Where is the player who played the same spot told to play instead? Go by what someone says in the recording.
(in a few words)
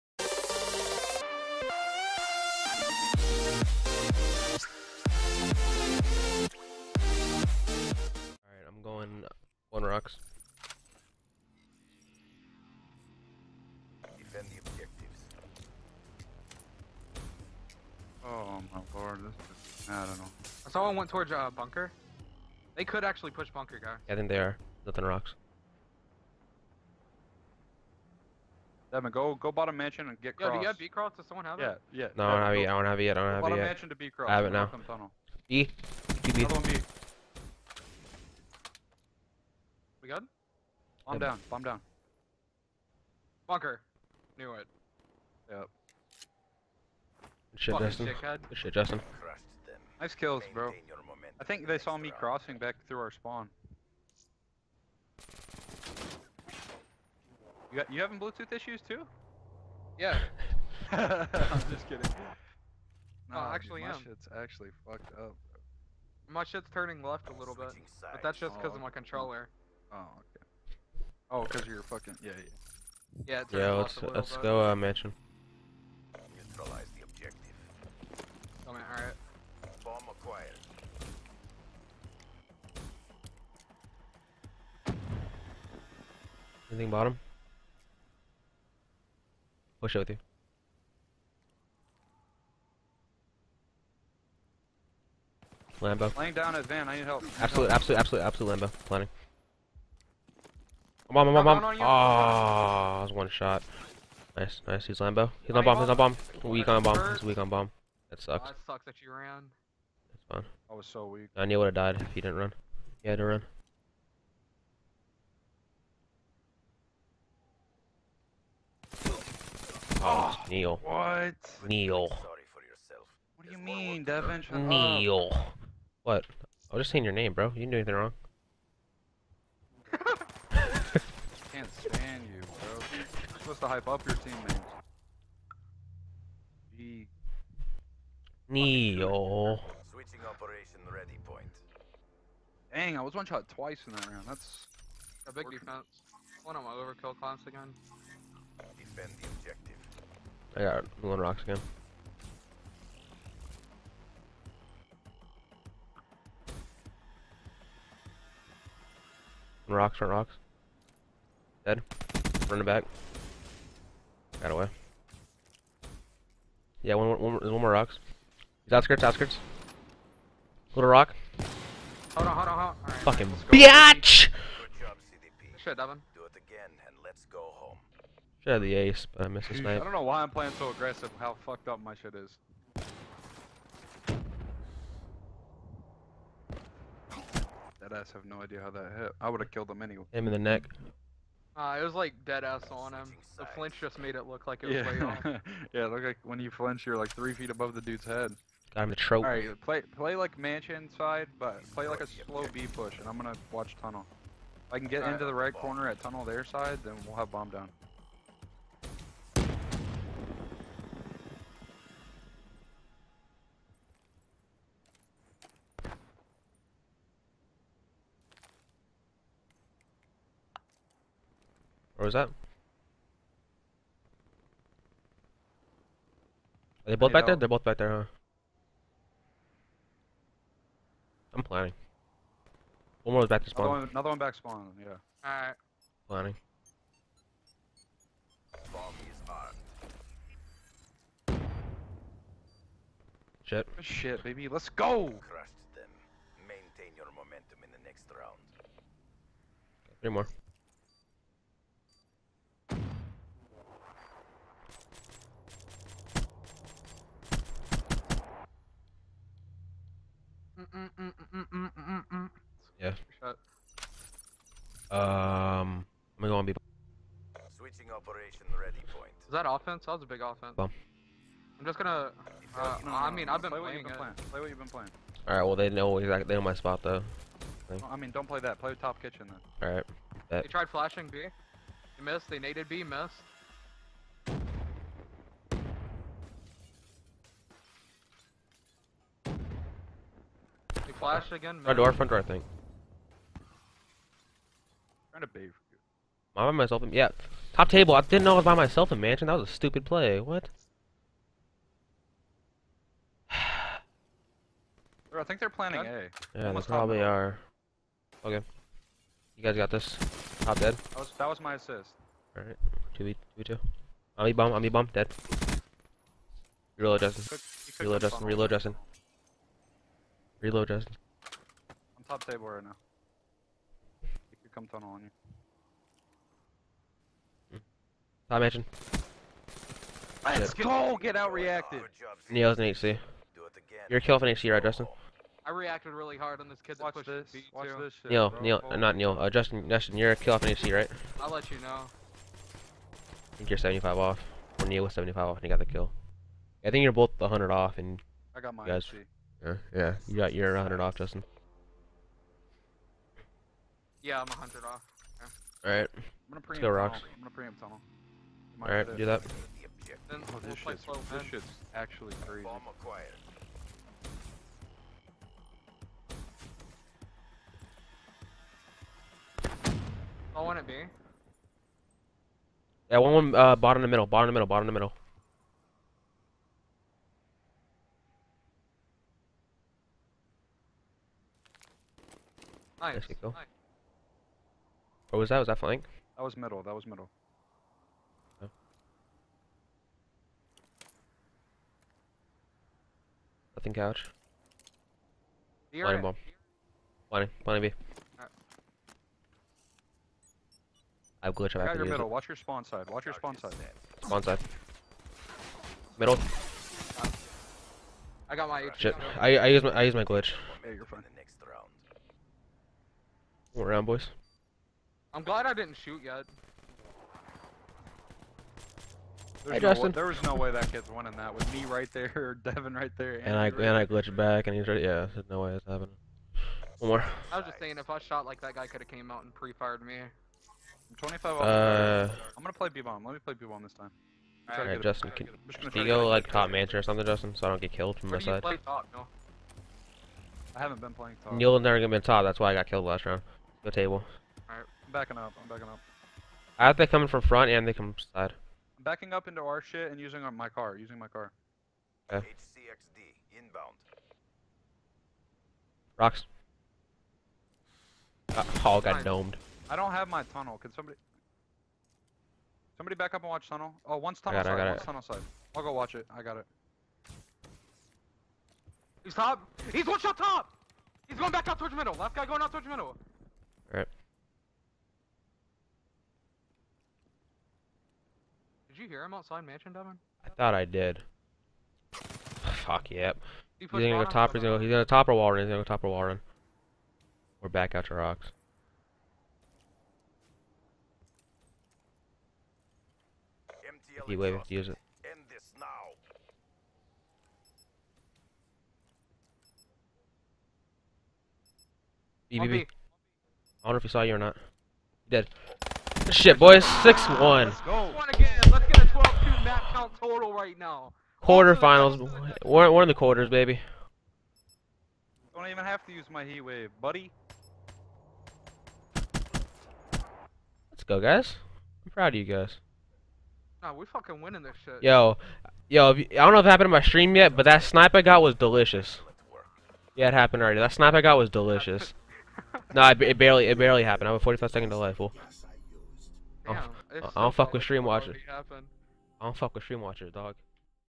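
top kitchen.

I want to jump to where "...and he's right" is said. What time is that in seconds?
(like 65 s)
424 s.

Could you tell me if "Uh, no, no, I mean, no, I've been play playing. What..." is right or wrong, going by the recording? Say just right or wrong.
right.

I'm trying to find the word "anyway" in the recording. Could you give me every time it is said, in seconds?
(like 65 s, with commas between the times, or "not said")
189 s.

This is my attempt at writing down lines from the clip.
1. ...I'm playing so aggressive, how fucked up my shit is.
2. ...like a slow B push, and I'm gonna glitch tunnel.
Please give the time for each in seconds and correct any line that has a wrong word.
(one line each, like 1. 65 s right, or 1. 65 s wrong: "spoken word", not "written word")
1. 180 s right
2. 201 s wrong: "watch", not "glitch".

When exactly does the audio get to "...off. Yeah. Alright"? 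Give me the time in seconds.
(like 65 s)
354 s.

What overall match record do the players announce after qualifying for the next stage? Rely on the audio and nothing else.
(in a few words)
6-1.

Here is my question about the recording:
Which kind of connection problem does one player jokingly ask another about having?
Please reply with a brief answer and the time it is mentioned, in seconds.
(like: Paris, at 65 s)
Bluetooth issues, at 58 s.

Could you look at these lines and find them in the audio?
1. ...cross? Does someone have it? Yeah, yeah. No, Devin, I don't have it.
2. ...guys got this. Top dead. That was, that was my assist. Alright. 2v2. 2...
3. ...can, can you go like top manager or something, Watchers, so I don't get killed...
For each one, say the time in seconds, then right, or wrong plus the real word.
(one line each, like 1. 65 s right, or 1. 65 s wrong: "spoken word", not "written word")
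1. 30 s right
2. 309 s right
3. 435 s wrong: "Justin", not "Watchers".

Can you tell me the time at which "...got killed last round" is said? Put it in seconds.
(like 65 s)
442 s.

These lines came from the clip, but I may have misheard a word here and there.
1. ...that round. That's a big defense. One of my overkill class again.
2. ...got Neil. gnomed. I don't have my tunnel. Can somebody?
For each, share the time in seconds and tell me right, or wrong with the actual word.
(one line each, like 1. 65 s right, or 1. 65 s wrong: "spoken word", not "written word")
1. 143 s right
2. 458 s wrong: "Fine", not "Neil".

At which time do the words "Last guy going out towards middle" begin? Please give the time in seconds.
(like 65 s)
471 s.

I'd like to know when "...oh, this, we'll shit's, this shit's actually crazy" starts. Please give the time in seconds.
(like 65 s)
360 s.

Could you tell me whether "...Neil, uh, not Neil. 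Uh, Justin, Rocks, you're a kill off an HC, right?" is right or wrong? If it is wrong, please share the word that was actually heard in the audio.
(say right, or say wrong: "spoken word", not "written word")
wrong: "Justin", not "Rocks".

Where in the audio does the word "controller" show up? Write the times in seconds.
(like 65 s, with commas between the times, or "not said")
68 s.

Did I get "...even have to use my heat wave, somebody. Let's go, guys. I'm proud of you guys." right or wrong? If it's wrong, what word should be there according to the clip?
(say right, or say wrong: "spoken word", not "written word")
wrong: "buddy", not "somebody".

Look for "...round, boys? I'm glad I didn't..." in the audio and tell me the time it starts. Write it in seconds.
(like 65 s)
413 s.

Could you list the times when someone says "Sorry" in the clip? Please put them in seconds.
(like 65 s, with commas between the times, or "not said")
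122 s.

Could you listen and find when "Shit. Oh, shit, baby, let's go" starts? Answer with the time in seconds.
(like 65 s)
243 s.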